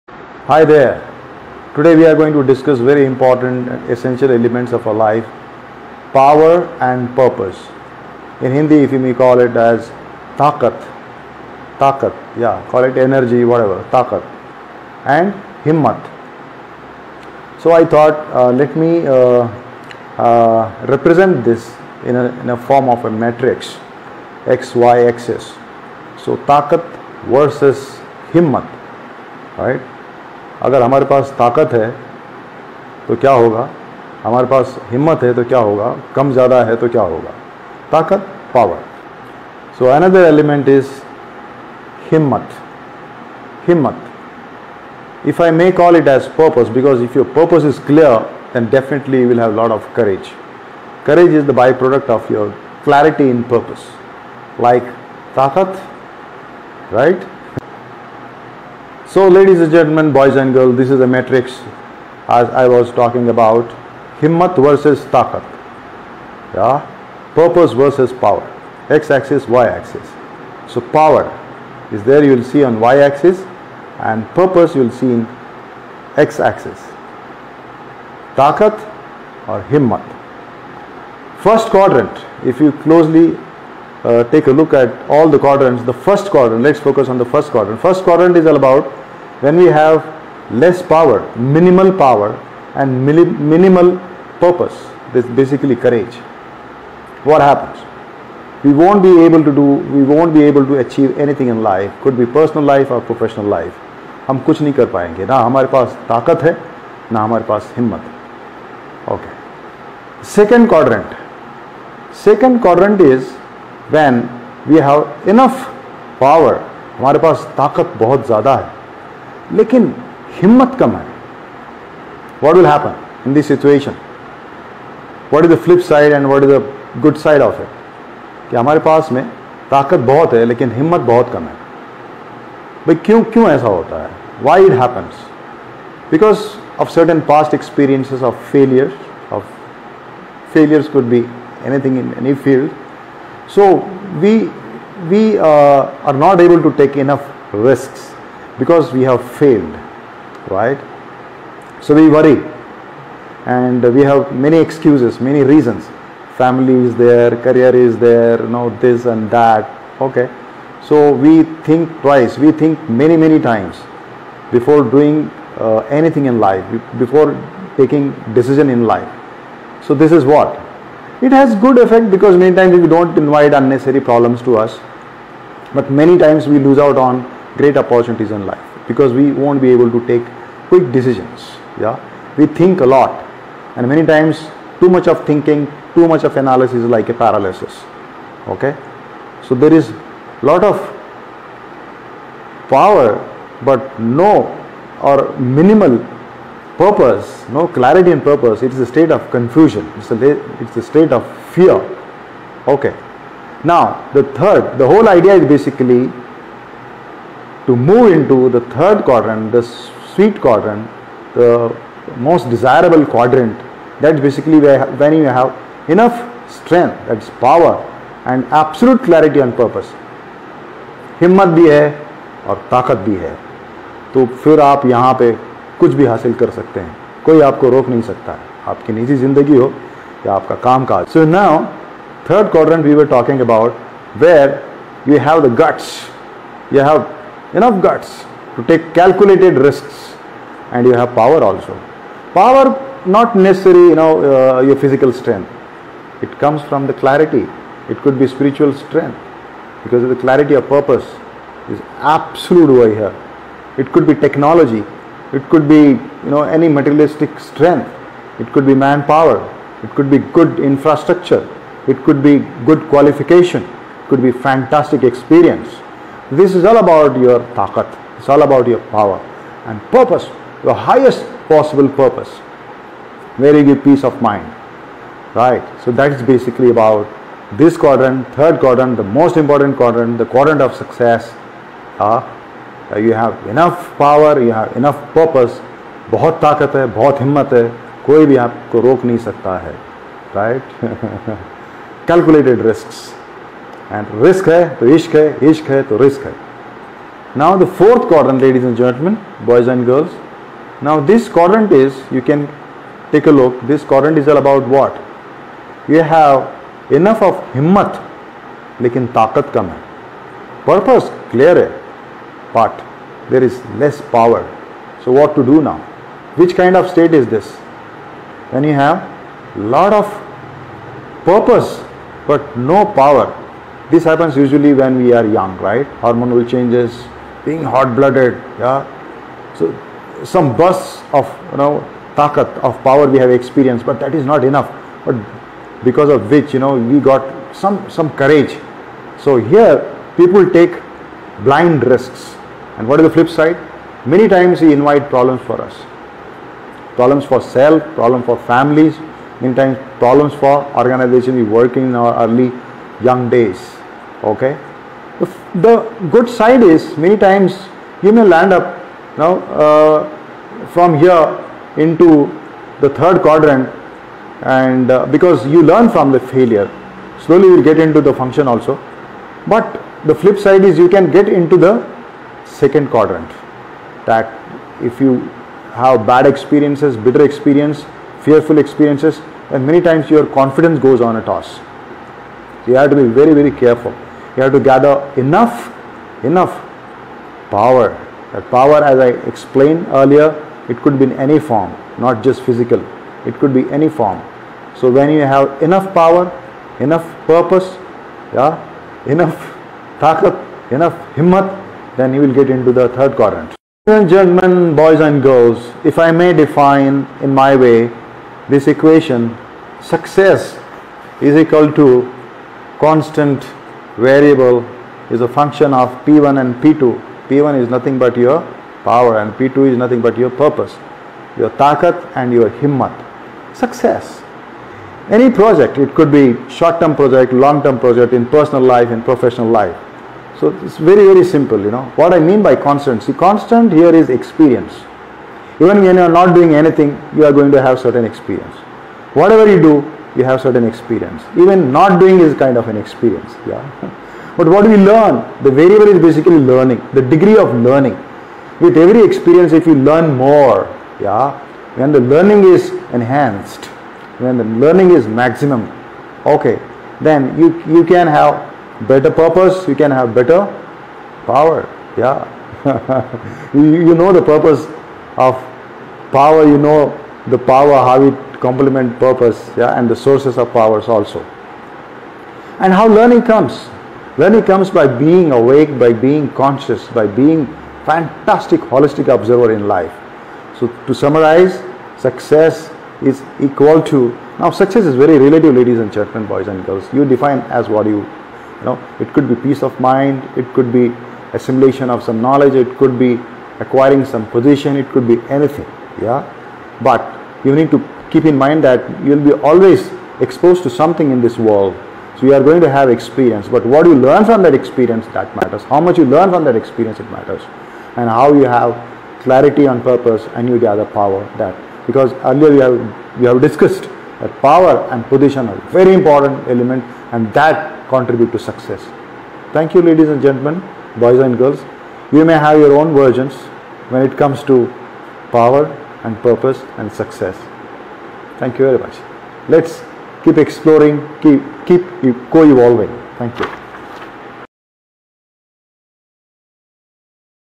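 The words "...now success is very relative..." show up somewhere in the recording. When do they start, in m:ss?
8:04.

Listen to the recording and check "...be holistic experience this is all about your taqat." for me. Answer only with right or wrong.
wrong.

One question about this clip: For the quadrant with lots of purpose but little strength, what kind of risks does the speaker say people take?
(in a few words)
Blind risks.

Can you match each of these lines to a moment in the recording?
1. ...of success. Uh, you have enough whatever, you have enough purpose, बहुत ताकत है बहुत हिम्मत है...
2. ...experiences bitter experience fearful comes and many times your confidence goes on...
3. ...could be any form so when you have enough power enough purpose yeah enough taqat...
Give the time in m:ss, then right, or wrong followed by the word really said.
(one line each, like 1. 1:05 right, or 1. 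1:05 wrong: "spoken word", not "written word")
1. 4:40 wrong: "power", not "whatever"
2. 6:16 wrong: "experiences", not "comes"
3. 6:33 right.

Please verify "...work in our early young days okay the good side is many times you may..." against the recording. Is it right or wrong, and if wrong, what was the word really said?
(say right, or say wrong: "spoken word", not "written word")
right.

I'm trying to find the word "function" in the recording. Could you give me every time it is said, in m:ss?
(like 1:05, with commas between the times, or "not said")
6:08, 6:55.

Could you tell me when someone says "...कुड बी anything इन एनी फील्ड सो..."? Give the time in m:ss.
2:20.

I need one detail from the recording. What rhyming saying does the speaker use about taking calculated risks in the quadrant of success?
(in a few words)
Risk hai to ishq hai.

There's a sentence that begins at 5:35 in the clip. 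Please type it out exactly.
But because of which you know we got some some courage.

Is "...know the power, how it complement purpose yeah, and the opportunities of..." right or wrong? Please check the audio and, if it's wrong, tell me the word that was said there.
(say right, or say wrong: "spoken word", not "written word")
wrong: "sources", not "opportunities".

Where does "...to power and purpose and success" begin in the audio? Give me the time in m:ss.
8:44.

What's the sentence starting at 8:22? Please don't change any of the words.
So you are going to have experience.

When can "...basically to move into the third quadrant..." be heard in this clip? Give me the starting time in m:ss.
3:25.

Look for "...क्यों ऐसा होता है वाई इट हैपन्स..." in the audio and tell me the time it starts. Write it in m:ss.
2:13.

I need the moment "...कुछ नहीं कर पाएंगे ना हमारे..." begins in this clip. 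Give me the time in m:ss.
1:44.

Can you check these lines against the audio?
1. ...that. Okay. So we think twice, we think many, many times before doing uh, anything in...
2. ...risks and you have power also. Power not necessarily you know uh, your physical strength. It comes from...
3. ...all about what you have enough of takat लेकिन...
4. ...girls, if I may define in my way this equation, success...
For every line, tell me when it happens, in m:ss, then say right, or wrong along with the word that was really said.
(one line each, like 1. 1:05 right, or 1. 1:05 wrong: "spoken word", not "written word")
1. 2:39 right
2. 3:59 right
3. 5:04 wrong: "himmat", not "takat"
4. 6:45 right.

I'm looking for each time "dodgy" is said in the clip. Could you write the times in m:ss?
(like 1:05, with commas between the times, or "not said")
not said.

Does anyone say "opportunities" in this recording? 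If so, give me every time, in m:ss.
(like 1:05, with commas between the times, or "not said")
2:57.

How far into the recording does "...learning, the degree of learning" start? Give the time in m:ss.
7:26.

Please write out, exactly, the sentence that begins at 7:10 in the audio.
So it's very, very simple, you know.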